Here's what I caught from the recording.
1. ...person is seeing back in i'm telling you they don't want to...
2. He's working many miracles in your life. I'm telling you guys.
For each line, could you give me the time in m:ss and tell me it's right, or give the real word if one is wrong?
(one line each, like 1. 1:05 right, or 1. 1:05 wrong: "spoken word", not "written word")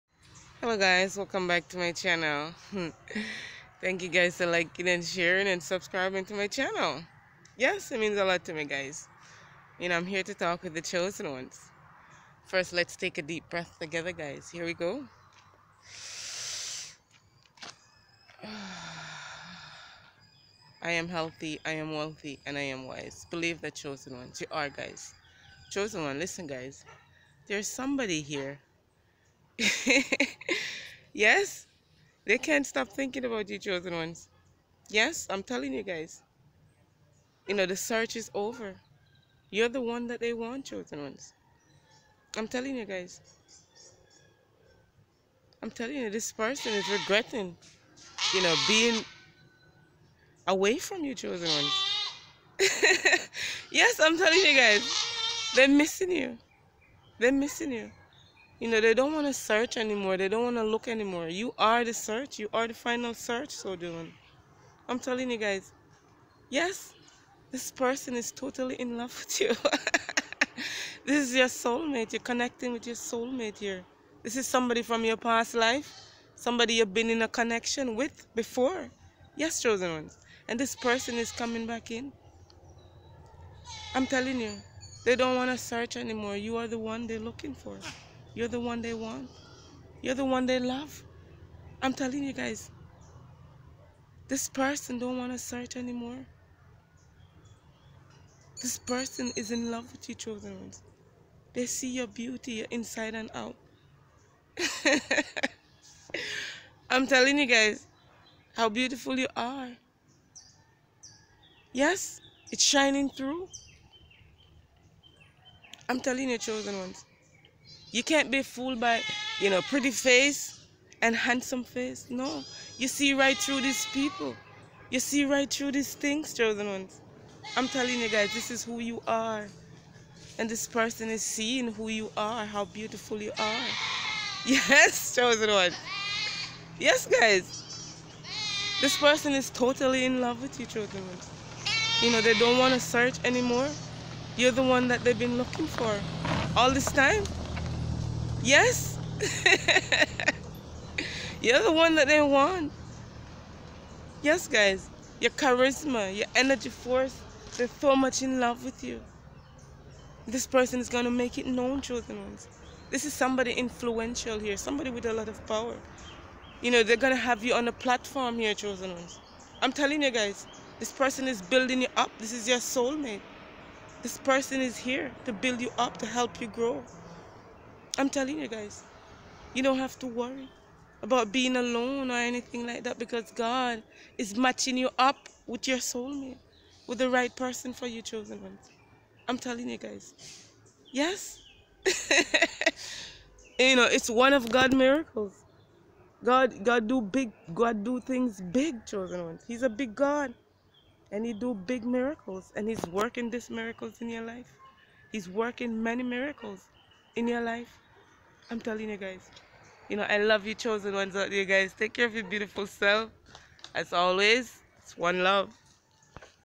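1. 1:20 wrong: "coming", not "seeing"
2. 3:25 right.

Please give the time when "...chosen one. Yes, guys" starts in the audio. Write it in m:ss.
2:15.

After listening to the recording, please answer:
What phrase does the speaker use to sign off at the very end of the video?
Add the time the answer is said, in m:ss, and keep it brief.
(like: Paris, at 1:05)
one love, at 3:34.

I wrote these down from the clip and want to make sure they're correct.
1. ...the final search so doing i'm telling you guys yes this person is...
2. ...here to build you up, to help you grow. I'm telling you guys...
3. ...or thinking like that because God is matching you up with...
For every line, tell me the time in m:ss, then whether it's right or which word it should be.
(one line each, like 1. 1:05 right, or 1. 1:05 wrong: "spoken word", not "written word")
1. 1:02 right
2. 2:54 right
3. 3:02 wrong: "anything", not "thinking".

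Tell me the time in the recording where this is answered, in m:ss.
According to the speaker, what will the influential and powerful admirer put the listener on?
2:47.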